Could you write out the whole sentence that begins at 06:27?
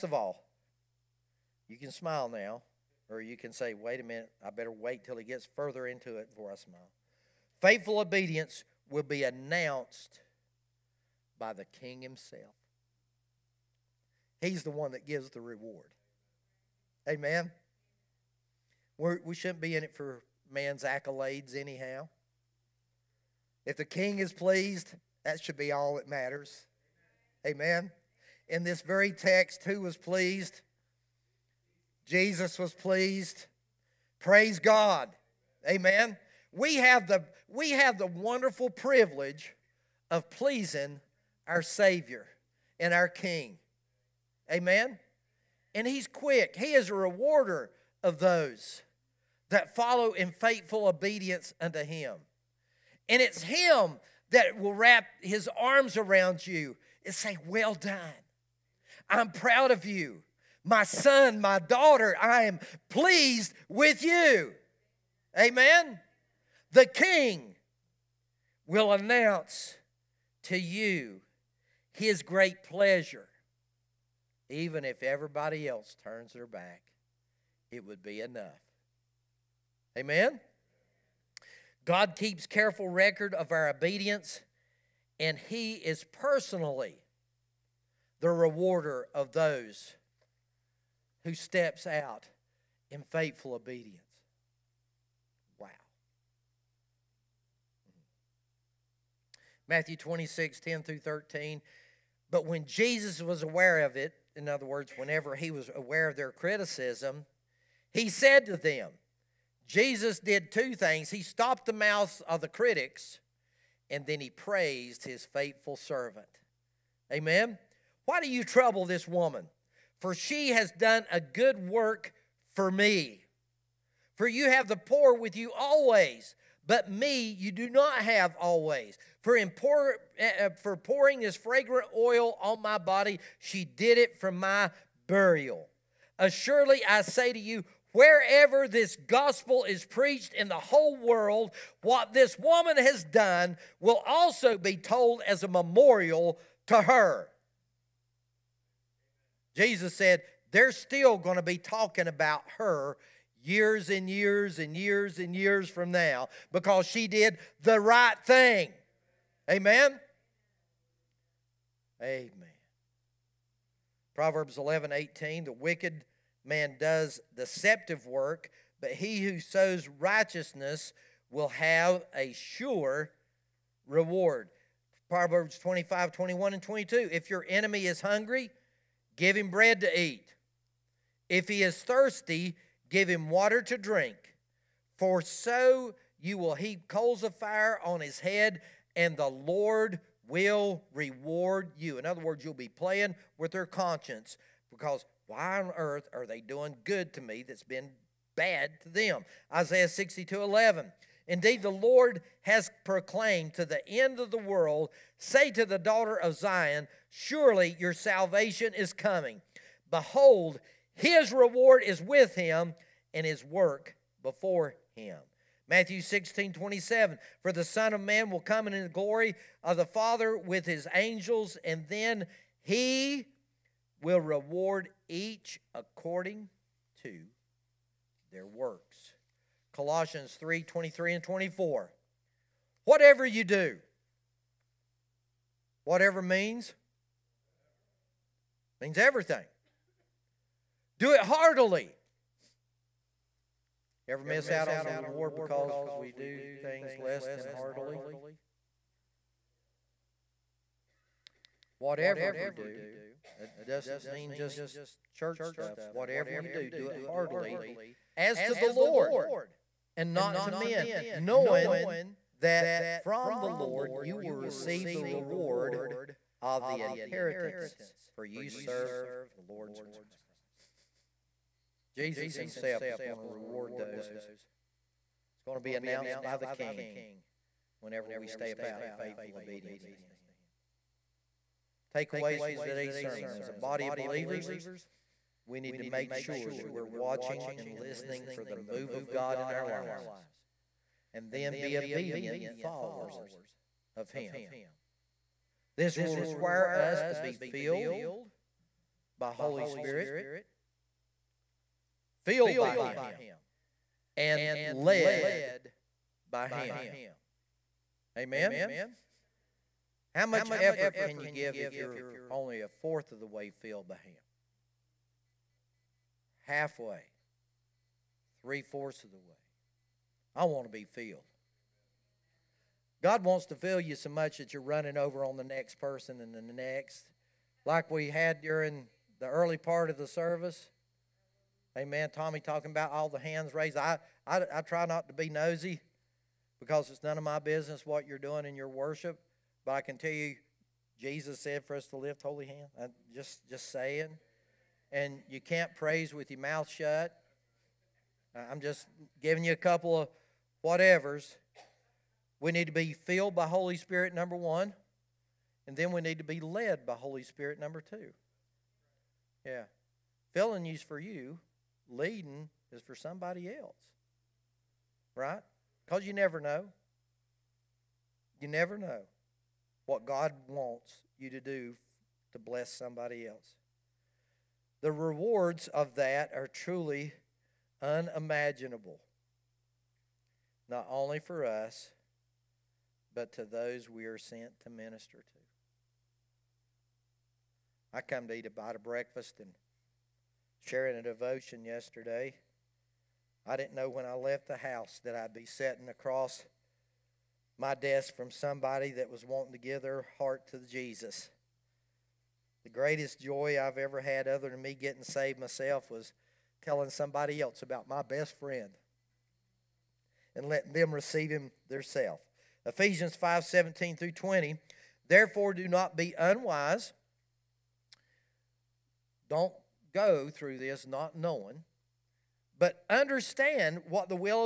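I come to eat a bite of breakfast and sharing a devotion yesterday.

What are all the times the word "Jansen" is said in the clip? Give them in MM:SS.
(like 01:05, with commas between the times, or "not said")
not said.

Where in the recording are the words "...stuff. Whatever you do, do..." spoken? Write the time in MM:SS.
04:15.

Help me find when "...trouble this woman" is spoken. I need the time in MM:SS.
01:58.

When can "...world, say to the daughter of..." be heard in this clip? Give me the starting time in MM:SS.
03:24.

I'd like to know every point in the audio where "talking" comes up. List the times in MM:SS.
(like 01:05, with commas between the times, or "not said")
02:31, 05:32.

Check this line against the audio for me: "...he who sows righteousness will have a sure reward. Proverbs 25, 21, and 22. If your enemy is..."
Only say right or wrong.
right.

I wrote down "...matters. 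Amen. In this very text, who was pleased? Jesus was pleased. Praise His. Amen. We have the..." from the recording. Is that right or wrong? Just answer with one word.
wrong.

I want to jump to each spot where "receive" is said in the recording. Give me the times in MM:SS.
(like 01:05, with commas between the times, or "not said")
04:24, 06:50.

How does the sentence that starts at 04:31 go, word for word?
Jesus himself is going to reward those.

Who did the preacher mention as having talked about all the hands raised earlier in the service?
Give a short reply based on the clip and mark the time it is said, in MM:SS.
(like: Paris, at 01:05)
Tommy, at 05:32.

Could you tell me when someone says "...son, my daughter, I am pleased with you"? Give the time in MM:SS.
01:00.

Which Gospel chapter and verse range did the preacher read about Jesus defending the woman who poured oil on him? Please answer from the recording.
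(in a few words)
Matthew 26:10-13.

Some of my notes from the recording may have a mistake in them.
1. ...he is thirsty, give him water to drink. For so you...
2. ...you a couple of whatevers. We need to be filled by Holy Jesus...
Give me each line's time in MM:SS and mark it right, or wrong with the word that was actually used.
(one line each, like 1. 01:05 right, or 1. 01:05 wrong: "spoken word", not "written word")
1. 03:01 right
2. 05:49 wrong: "Spirit", not "Jesus".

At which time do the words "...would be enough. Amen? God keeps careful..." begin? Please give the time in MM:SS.
01:17.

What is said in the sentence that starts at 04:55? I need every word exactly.
This will require us to be filled by Holy Spirit, filled by Him, and led by Him.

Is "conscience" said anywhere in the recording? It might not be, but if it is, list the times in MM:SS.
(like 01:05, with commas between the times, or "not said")
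03:13.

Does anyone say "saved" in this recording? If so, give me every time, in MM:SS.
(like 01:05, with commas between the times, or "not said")
06:45.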